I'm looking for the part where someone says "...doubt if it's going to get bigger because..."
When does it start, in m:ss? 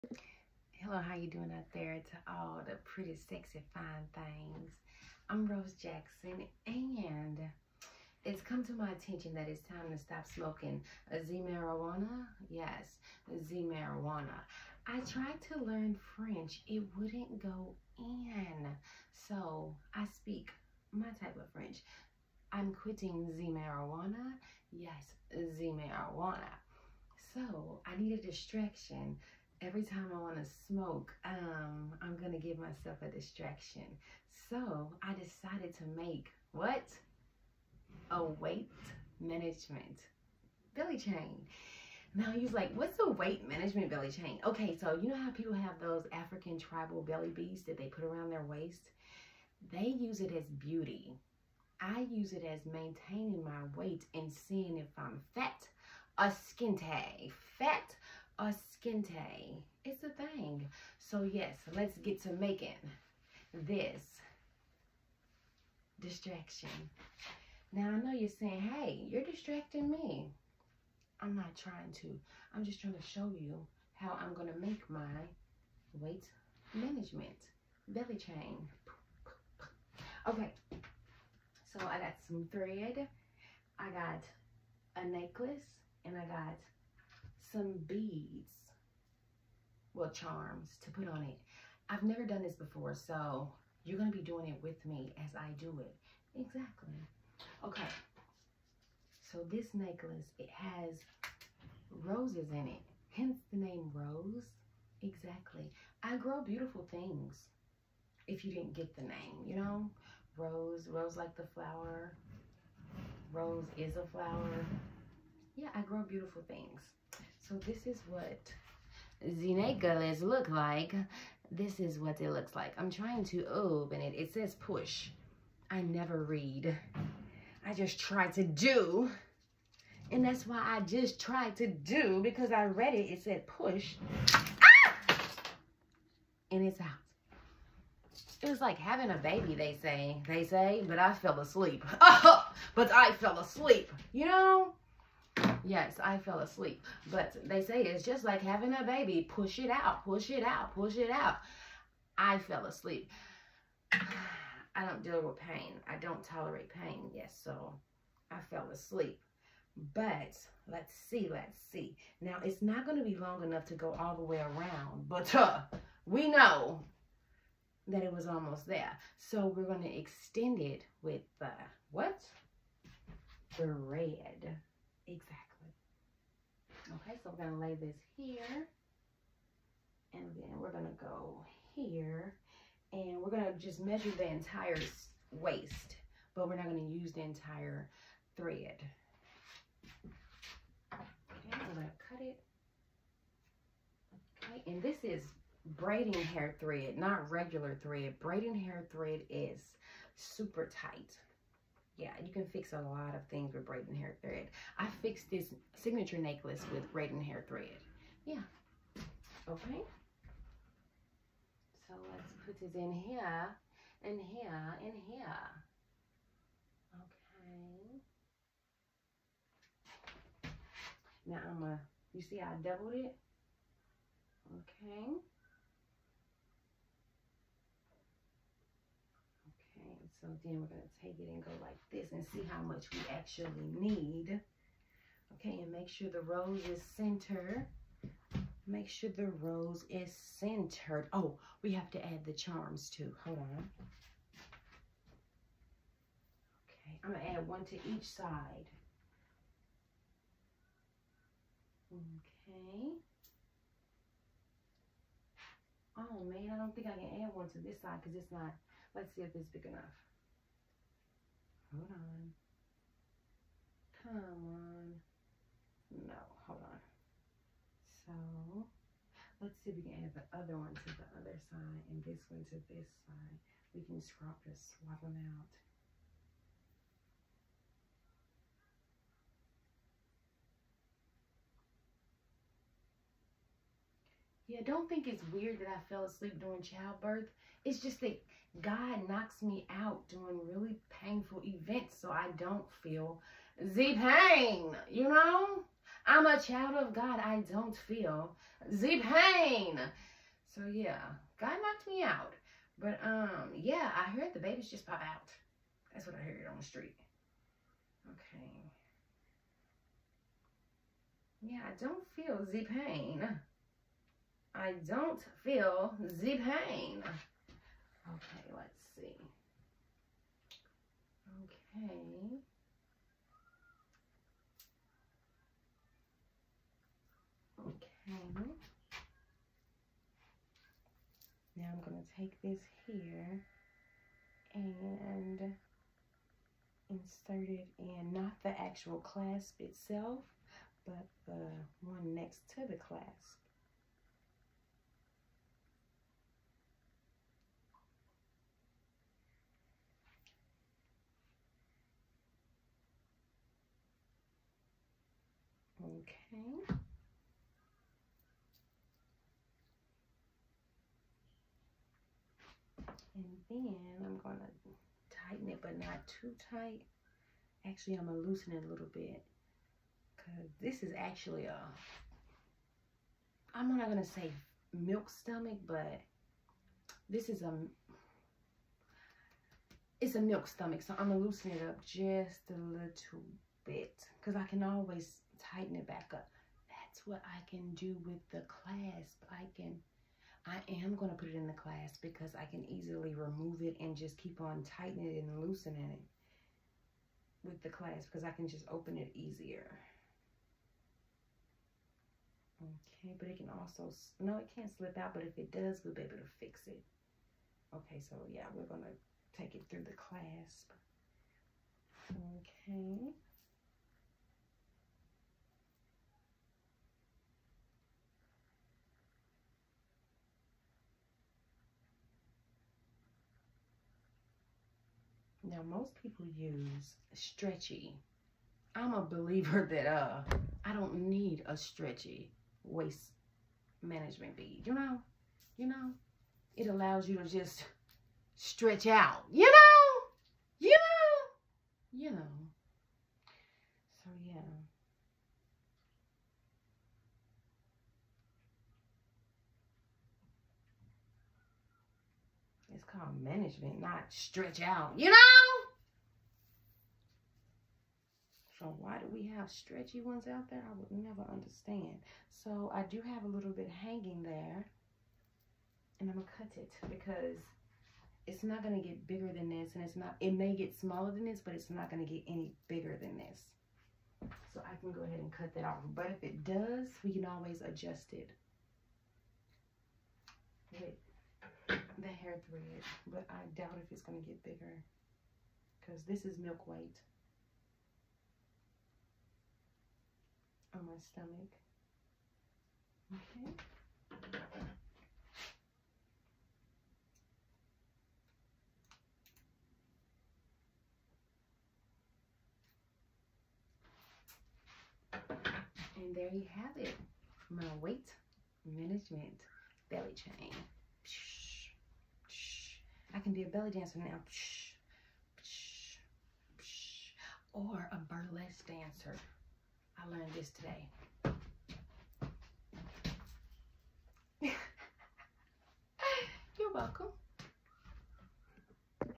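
8:03.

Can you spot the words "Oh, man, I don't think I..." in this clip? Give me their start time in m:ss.
4:15.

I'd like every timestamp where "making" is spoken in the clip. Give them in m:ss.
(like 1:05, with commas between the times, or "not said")
1:02.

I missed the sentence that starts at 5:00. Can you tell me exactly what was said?
So yeah, God knocked me out.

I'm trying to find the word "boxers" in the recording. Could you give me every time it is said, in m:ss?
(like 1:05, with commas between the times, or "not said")
not said.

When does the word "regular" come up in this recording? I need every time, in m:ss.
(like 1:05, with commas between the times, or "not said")
3:17.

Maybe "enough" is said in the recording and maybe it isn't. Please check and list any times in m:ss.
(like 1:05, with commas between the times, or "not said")
2:43, 4:19.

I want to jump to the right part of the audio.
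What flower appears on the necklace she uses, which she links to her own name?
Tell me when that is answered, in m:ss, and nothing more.
1:42.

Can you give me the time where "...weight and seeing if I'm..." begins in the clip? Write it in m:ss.
0:53.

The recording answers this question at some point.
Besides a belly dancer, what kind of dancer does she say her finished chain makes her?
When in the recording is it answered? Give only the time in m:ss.
8:38.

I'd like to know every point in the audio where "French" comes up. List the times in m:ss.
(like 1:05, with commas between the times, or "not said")
0:16, 0:21.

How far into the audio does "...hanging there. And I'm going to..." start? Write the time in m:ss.
7:43.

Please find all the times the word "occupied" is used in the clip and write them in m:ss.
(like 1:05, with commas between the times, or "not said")
not said.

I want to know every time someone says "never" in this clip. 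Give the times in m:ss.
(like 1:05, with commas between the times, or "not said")
1:32, 2:05, 7:40.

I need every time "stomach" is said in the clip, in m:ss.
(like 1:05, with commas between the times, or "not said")
6:15, 6:20, 8:10.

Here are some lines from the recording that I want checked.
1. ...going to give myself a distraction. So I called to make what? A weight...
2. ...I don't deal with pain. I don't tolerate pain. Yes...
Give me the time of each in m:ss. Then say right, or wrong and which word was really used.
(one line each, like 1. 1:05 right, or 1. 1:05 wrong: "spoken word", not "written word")
1. 0:32 wrong: "decided", not "called"
2. 2:33 right.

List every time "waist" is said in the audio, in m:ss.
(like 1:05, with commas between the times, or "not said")
0:48, 3:05, 7:12.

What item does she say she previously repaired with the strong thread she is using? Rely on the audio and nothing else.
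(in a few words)
Signature necklace.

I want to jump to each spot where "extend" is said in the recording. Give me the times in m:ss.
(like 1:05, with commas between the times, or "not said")
2:49.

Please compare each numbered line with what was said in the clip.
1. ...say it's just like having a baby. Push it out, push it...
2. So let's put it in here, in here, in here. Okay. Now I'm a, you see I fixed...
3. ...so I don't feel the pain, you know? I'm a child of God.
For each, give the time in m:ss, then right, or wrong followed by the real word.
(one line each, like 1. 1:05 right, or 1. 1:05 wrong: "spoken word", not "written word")
1. 2:27 right
2. 3:31 wrong: "doubled", not "fixed"
3. 4:52 right.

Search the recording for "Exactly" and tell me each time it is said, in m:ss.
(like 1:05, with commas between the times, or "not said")
1:36, 1:45, 2:55.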